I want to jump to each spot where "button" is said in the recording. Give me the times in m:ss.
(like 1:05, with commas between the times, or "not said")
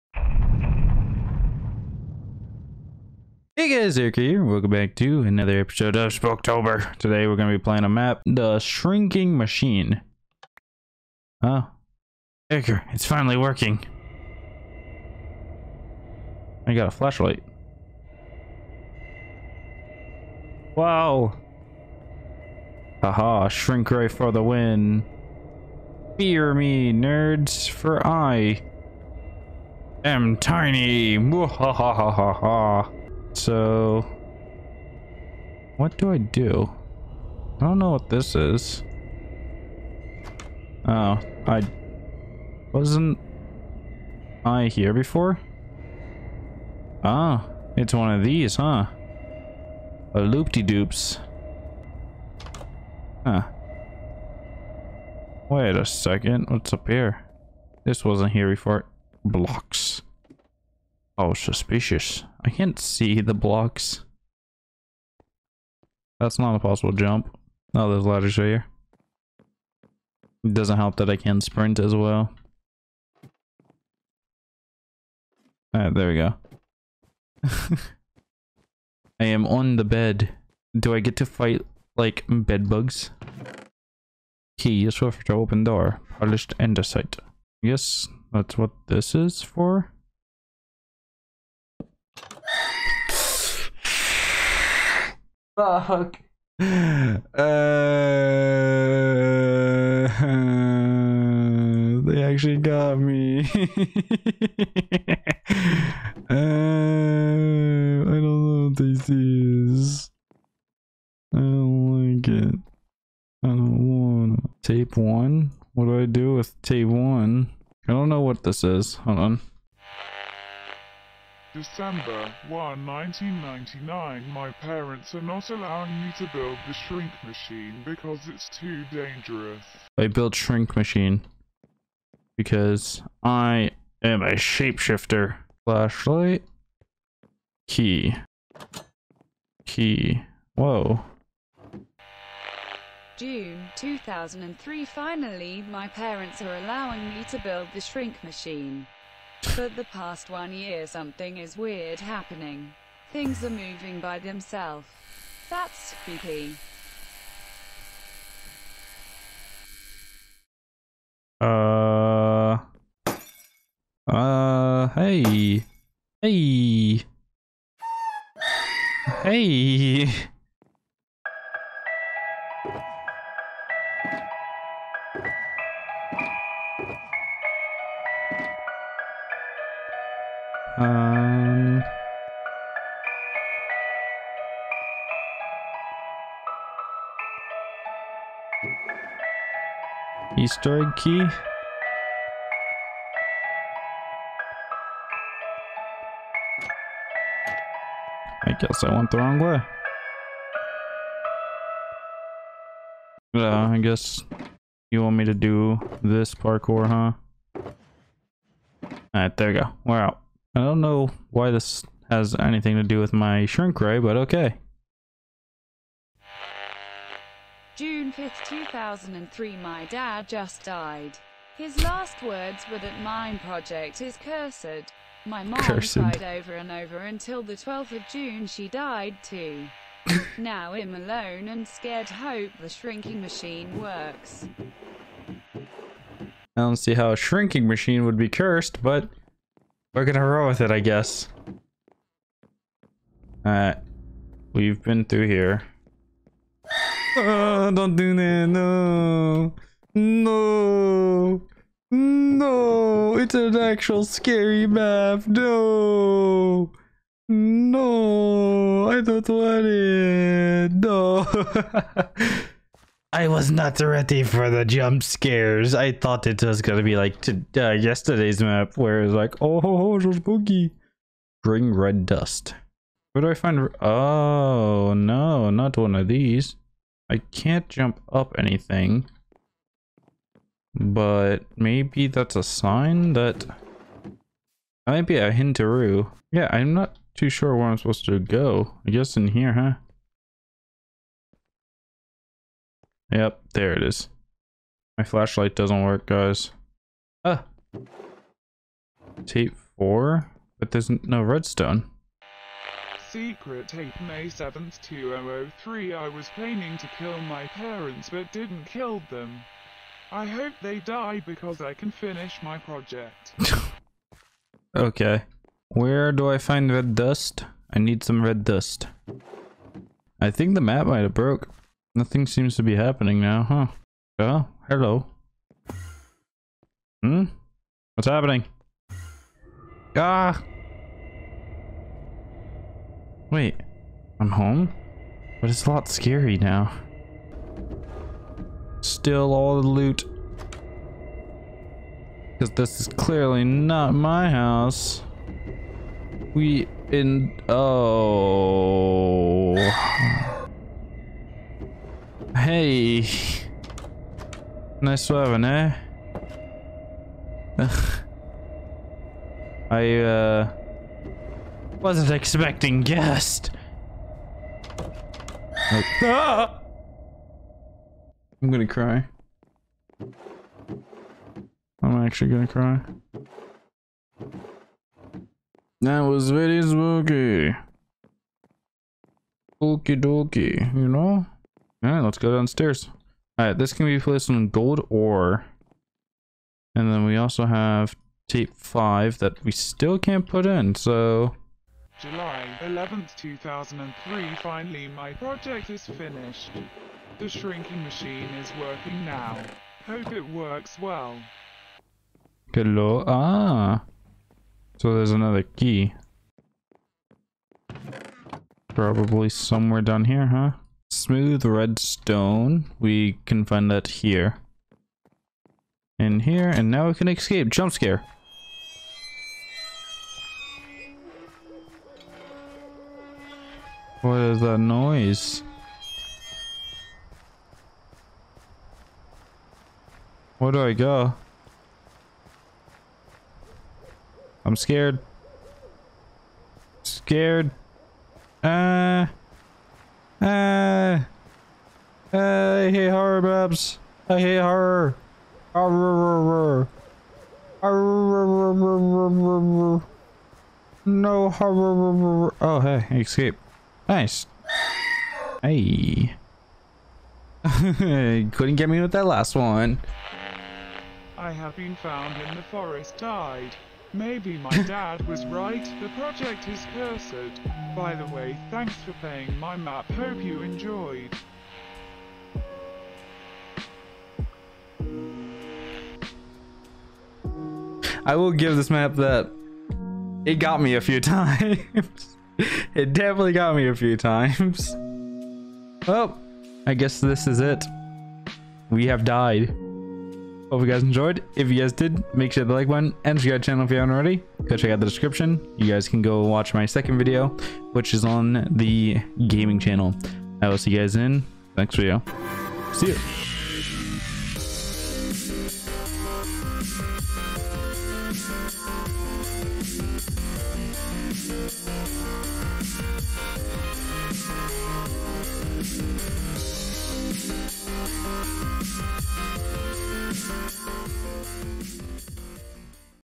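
8:12.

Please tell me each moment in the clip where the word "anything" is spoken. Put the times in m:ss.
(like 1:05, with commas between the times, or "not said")
3:32, 4:38.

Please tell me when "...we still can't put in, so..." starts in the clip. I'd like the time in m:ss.
6:29.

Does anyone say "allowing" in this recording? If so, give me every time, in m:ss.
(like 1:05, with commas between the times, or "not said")
2:05, 2:26.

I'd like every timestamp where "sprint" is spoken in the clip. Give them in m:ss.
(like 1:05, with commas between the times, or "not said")
1:11.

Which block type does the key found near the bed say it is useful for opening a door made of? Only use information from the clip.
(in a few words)
Polished andesite.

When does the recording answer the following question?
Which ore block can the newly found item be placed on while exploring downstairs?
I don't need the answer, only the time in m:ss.
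6:24.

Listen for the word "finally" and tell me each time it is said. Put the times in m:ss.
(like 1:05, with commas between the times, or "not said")
0:13, 2:24, 6:34.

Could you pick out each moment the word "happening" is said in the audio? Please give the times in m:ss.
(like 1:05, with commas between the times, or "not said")
2:31, 5:22, 5:28.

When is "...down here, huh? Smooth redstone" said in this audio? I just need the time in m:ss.
6:49.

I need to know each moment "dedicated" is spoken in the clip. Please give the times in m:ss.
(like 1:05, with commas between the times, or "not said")
not said.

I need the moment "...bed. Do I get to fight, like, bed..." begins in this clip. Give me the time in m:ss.
1:19.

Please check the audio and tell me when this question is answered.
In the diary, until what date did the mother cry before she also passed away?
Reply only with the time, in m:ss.
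3:47.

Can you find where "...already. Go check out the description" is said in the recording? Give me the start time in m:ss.
8:13.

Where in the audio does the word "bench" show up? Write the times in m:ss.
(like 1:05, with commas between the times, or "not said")
not said.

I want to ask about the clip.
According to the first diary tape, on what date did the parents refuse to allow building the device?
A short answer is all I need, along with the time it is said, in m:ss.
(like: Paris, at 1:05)
December 1, 1999, at 2:01.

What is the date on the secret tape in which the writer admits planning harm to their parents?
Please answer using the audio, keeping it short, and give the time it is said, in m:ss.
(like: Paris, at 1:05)
May 7th, 2003, at 5:03.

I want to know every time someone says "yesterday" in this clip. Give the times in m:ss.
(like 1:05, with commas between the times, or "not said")
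4:27.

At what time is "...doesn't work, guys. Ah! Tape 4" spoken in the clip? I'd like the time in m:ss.
4:55.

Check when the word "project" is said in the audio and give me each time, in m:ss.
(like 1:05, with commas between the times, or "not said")
3:43, 5:12, 6:35, 7:45.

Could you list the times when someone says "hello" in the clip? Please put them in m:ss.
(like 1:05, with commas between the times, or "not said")
5:24, 6:42.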